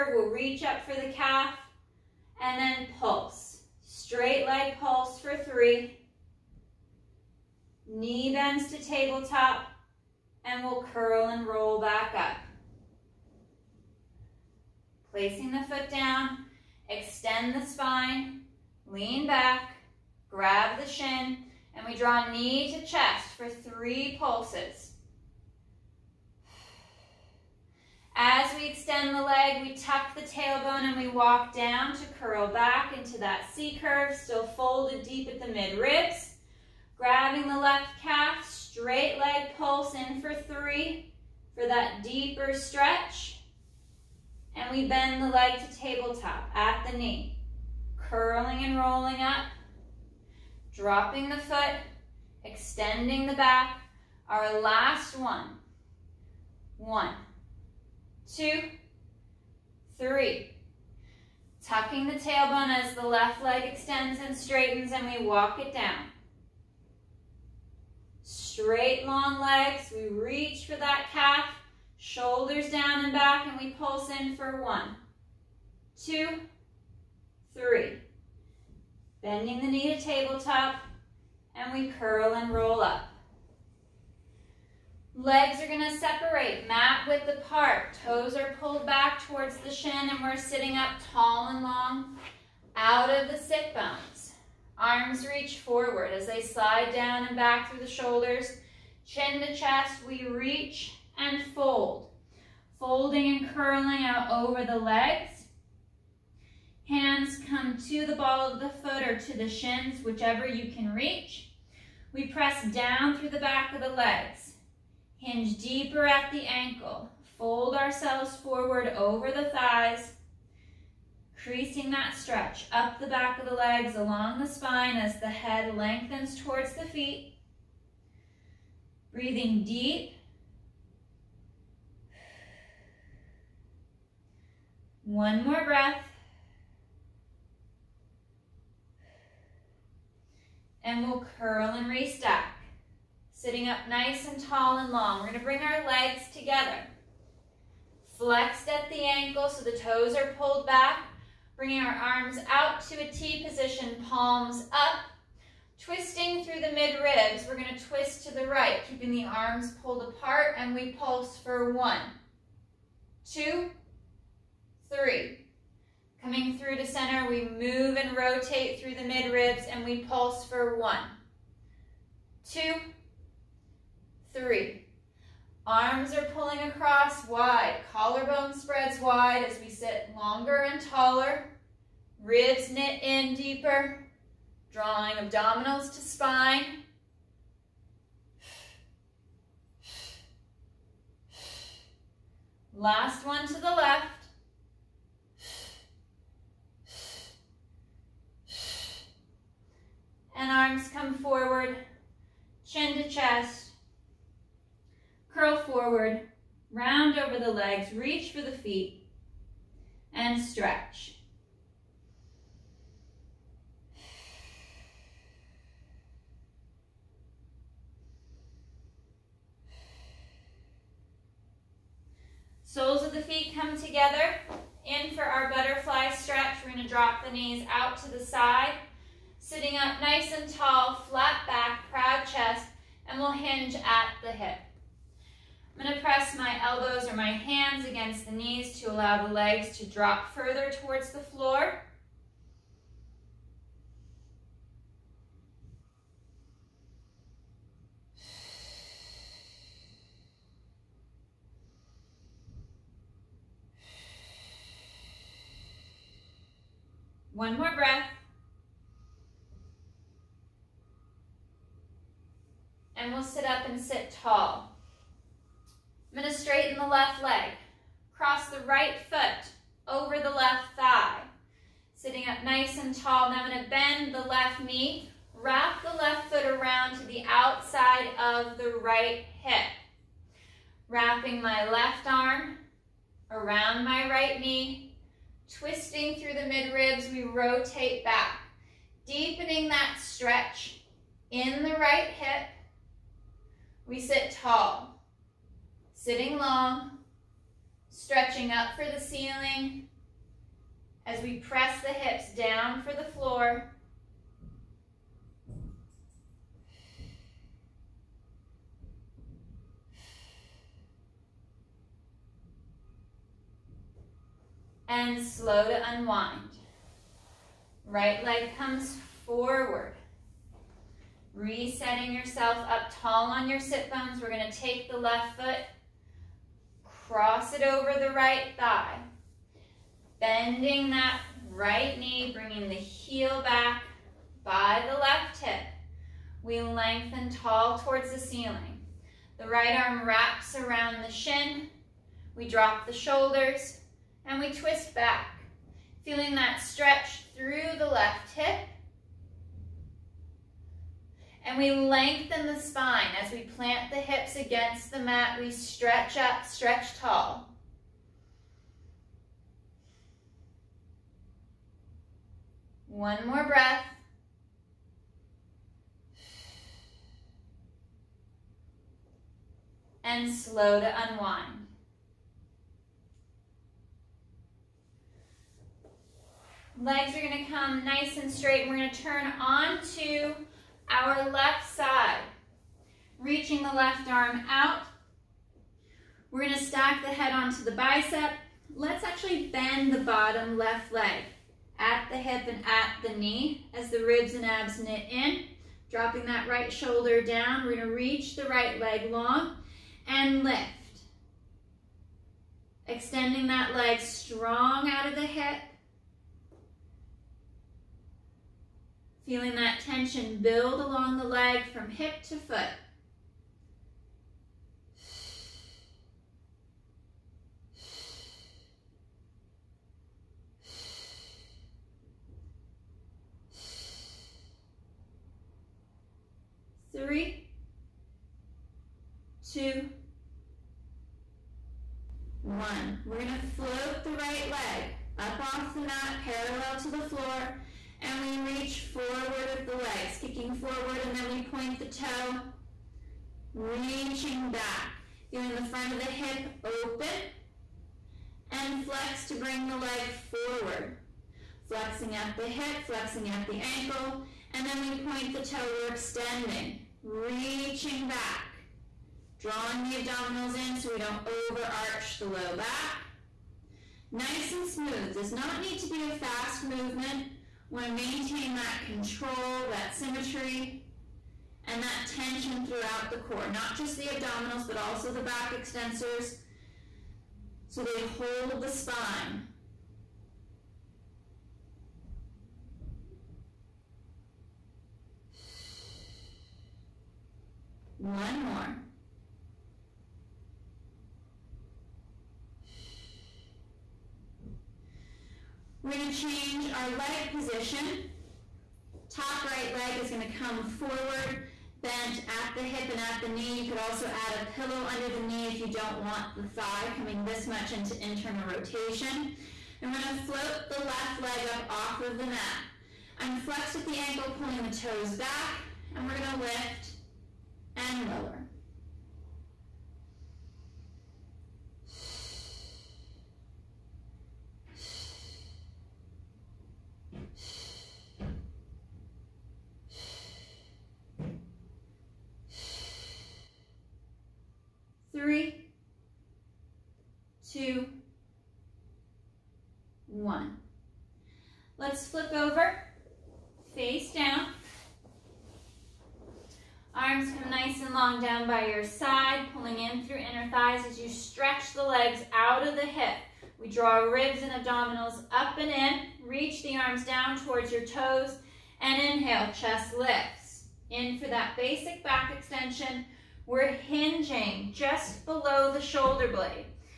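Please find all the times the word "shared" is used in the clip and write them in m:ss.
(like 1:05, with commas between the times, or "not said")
not said.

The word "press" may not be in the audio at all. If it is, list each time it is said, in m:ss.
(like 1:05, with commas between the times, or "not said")
1:52, 3:55, 5:01.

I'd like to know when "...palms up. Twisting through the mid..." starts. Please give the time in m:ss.
2:34.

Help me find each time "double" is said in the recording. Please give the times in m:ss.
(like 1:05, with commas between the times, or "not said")
not said.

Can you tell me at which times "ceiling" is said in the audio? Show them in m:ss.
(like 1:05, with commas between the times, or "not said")
4:58, 5:38.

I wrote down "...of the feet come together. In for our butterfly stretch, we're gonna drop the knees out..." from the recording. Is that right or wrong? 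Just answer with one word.
right.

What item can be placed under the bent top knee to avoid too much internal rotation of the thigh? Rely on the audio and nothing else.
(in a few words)
A pillow.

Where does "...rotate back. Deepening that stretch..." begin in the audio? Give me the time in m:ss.
4:47.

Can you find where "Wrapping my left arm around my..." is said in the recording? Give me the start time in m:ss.
4:40.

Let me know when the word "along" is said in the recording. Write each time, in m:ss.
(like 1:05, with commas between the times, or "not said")
2:03, 6:50.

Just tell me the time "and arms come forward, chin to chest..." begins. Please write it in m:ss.
3:20.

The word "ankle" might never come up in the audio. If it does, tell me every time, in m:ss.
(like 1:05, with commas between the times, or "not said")
1:56, 2:29, 7:33, 8:33.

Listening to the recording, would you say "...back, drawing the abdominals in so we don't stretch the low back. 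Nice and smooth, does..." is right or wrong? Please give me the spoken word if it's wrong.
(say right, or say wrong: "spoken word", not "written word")
wrong: "overarch", not "stretch".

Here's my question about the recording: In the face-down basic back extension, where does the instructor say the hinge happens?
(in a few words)
Below the shoulder blade.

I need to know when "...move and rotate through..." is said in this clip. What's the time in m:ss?
2:47.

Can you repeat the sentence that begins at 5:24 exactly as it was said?
We're gonna take the left foot, cross it over the right thigh.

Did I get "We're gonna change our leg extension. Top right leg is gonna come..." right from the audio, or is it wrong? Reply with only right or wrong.
wrong.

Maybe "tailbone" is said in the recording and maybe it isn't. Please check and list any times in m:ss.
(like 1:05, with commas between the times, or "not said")
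0:30, 1:02.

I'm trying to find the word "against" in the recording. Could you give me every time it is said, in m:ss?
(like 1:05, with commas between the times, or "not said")
3:57, 5:54.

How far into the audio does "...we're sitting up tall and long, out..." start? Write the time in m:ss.
1:30.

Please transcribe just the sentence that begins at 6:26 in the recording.
We're gonna stack the head onto the bicep.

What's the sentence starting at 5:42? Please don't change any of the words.
We drop the shoulders and we twist back.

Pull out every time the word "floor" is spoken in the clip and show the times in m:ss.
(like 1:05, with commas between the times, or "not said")
4:01, 5:03, 7:16.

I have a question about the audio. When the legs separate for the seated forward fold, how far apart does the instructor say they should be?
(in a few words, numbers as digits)
Mat width apart.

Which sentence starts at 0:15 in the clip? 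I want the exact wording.
Placing the foot down, extend the spine, lean back, grab the shin, and we draw knee to chest for three pulses.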